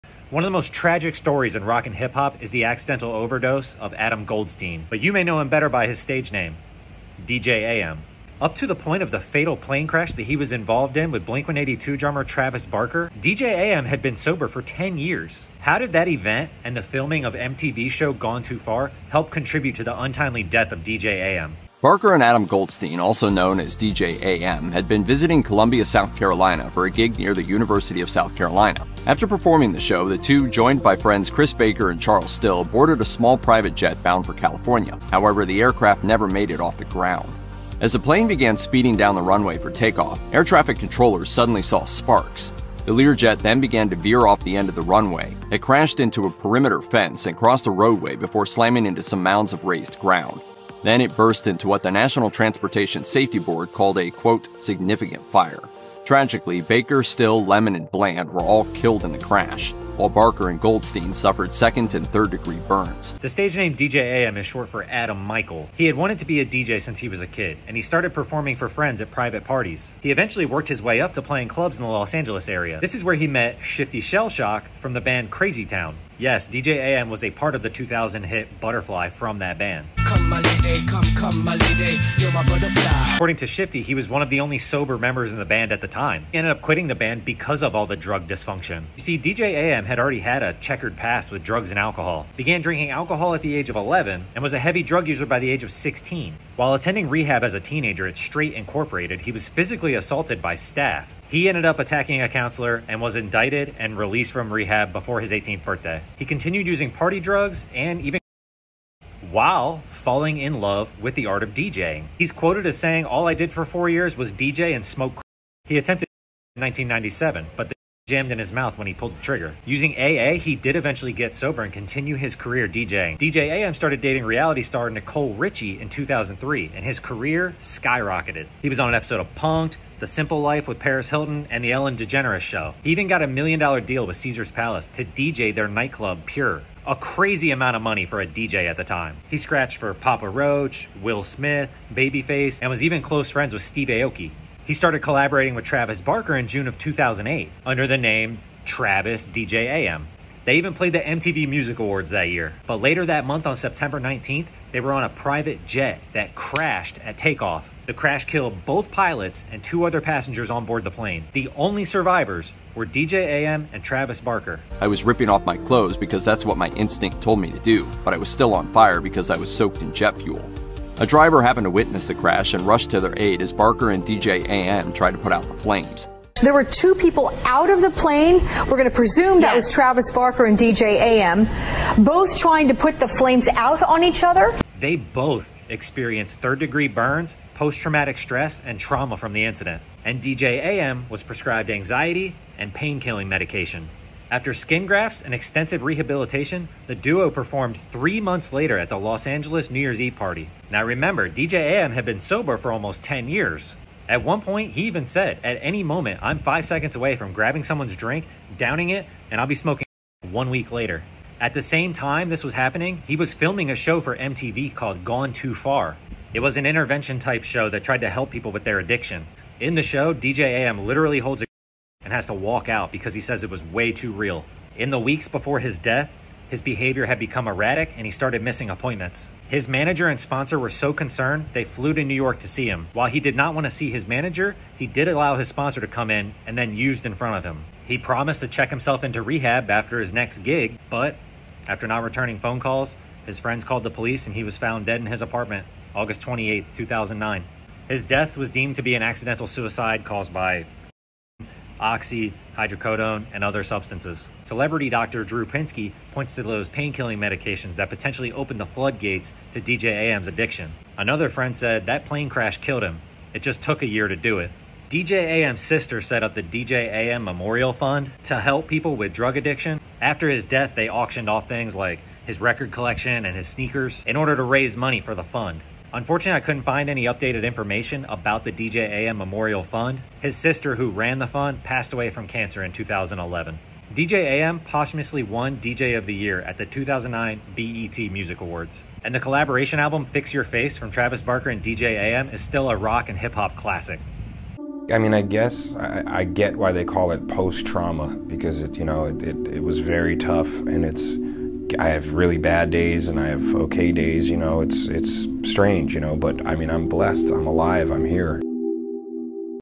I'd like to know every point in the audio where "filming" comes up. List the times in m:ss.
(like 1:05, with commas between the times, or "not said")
0:16, 3:33.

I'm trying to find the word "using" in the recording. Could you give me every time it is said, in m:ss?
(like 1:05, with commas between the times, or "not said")
1:46, 1:59.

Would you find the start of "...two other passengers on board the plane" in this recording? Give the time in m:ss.
2:39.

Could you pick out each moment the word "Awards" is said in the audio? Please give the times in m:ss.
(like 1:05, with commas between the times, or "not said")
2:31, 4:48.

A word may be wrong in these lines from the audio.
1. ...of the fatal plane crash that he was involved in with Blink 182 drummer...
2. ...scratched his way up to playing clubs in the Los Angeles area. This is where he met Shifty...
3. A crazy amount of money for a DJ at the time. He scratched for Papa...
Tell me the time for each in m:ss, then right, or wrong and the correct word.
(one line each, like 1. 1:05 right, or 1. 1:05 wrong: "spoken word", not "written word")
1. 0:09 right
2. 1:10 wrong: "worked", not "scratched"
3. 2:16 right.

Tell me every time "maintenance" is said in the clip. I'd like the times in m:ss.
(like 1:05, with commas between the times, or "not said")
not said.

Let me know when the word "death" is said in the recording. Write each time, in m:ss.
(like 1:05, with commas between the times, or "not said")
0:20, 3:45, 4:08, 4:30.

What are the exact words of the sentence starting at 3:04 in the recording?
They both experienced third degree burns, post traumatic stress, and trauma from the incident.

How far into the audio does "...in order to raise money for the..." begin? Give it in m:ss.
4:34.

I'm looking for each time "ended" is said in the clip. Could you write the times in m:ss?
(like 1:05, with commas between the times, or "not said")
1:26, 1:41.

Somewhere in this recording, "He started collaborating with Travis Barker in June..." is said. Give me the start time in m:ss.
2:24.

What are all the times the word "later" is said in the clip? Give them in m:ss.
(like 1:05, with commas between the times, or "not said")
2:32, 3:18, 3:30.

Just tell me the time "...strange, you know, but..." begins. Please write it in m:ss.
5:05.